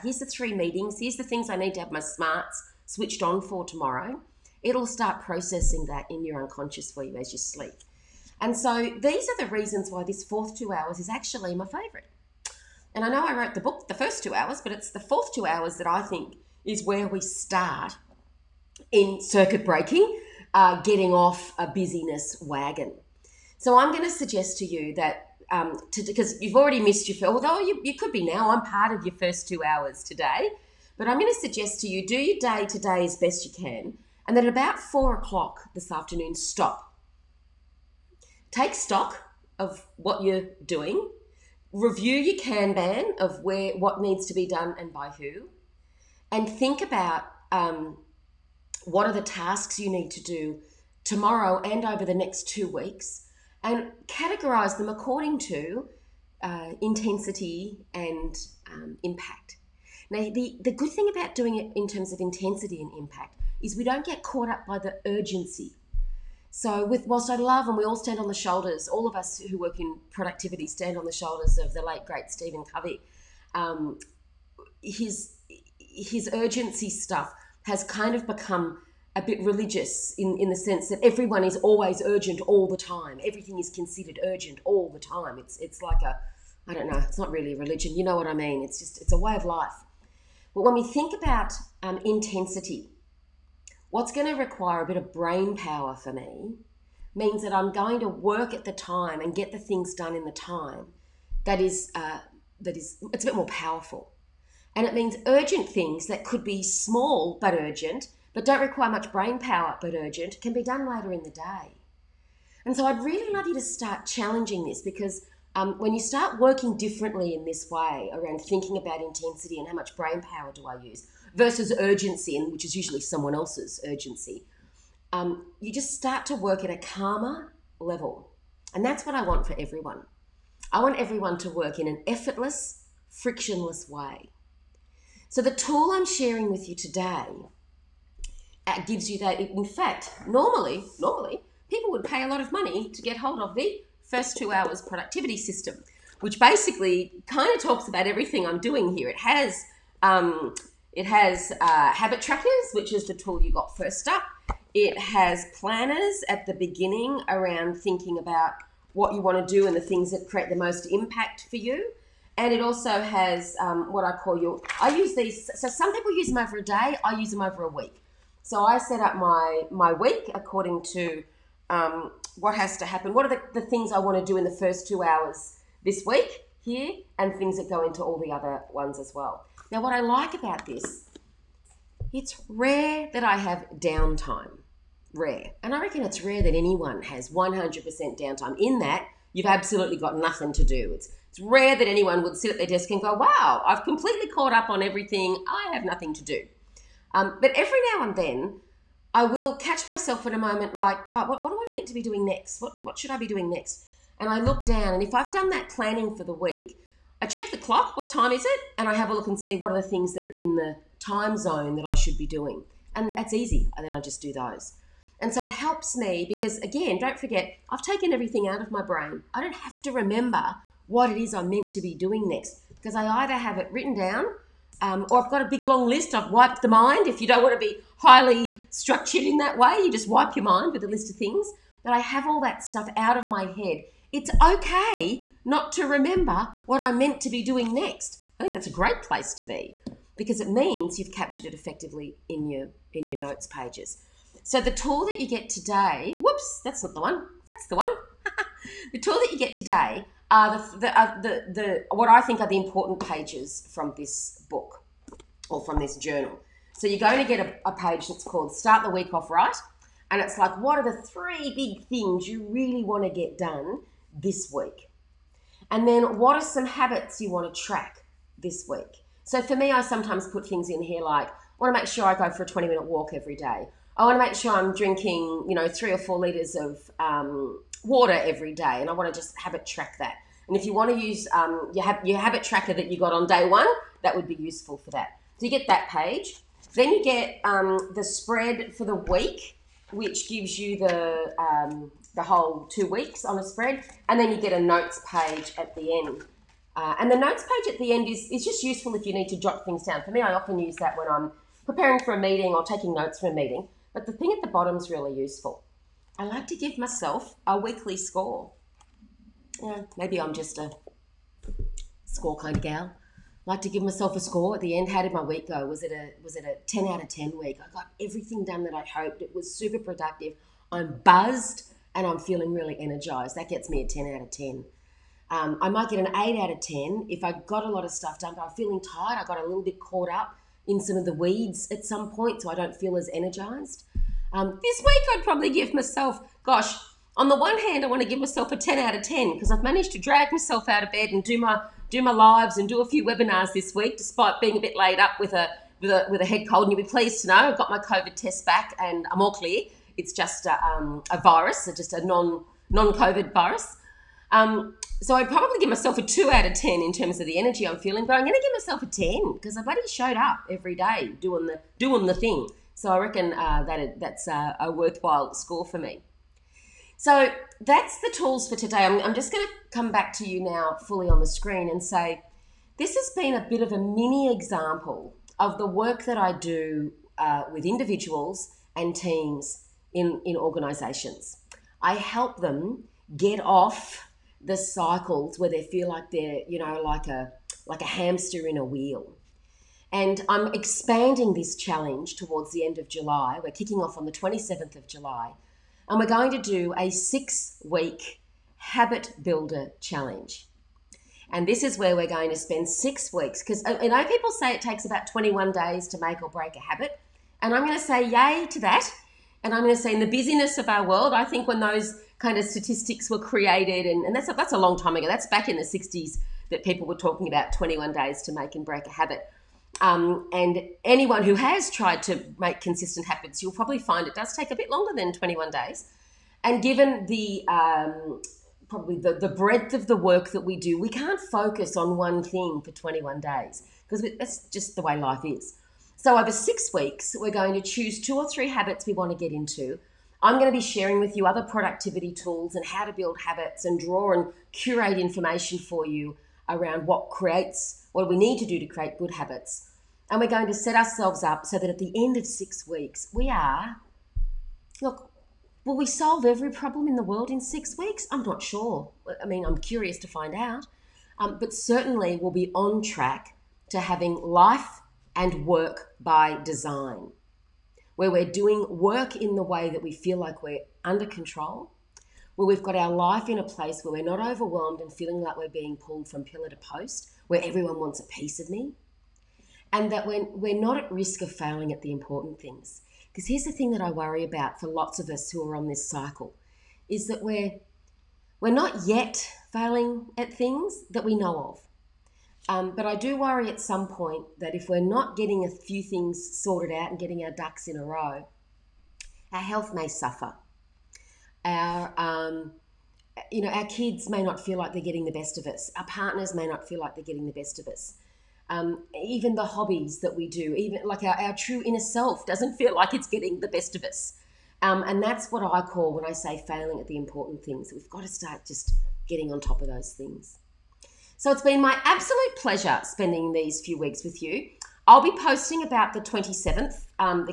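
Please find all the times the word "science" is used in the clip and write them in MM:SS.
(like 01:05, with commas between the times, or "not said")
not said.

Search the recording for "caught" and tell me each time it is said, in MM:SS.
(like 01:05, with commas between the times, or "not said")
01:04, 03:14, 05:29.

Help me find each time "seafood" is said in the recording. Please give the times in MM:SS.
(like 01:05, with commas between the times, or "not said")
not said.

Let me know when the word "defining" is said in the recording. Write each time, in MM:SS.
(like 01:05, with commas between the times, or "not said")
not said.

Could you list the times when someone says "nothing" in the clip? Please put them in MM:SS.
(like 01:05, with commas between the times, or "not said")
03:10, 03:15.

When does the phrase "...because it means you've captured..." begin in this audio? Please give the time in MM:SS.
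04:00.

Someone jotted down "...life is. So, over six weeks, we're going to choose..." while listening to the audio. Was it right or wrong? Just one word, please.
right.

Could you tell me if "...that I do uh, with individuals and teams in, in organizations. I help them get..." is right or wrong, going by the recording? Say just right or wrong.
right.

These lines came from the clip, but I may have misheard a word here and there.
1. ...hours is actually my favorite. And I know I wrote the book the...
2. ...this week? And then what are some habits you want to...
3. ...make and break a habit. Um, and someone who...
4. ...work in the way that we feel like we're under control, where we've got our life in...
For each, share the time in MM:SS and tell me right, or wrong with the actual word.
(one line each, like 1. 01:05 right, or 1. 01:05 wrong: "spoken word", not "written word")
1. 00:10 right
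2. 04:24 right
3. 06:58 wrong: "anyone", not "someone"
4. 07:48 right.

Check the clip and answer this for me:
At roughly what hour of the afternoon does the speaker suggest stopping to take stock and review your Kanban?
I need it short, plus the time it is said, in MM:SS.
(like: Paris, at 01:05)
4 o'clock, at 00:34.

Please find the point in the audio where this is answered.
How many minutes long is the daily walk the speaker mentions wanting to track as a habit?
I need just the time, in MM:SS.
04:32.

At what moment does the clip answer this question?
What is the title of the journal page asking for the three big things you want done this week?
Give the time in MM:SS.
04:18.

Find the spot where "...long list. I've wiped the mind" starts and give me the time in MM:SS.
03:45.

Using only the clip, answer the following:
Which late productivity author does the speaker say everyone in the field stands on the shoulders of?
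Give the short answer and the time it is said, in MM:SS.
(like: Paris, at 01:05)
Stephen Covey, at 01:12.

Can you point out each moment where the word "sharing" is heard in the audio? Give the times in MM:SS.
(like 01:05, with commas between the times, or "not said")
02:16, 07:20.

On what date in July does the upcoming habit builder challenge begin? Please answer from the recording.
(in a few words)
27 July.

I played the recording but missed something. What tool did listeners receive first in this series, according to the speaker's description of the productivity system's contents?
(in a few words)
Habit trackers.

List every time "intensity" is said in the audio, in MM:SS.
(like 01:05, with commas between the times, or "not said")
00:56, 01:02, 01:32, 01:59.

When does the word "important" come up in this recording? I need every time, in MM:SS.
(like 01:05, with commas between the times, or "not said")
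04:12, 08:01, 08:36.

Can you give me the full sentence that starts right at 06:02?
So I reckon uh, that it, that's a, a, worthwhile score for me.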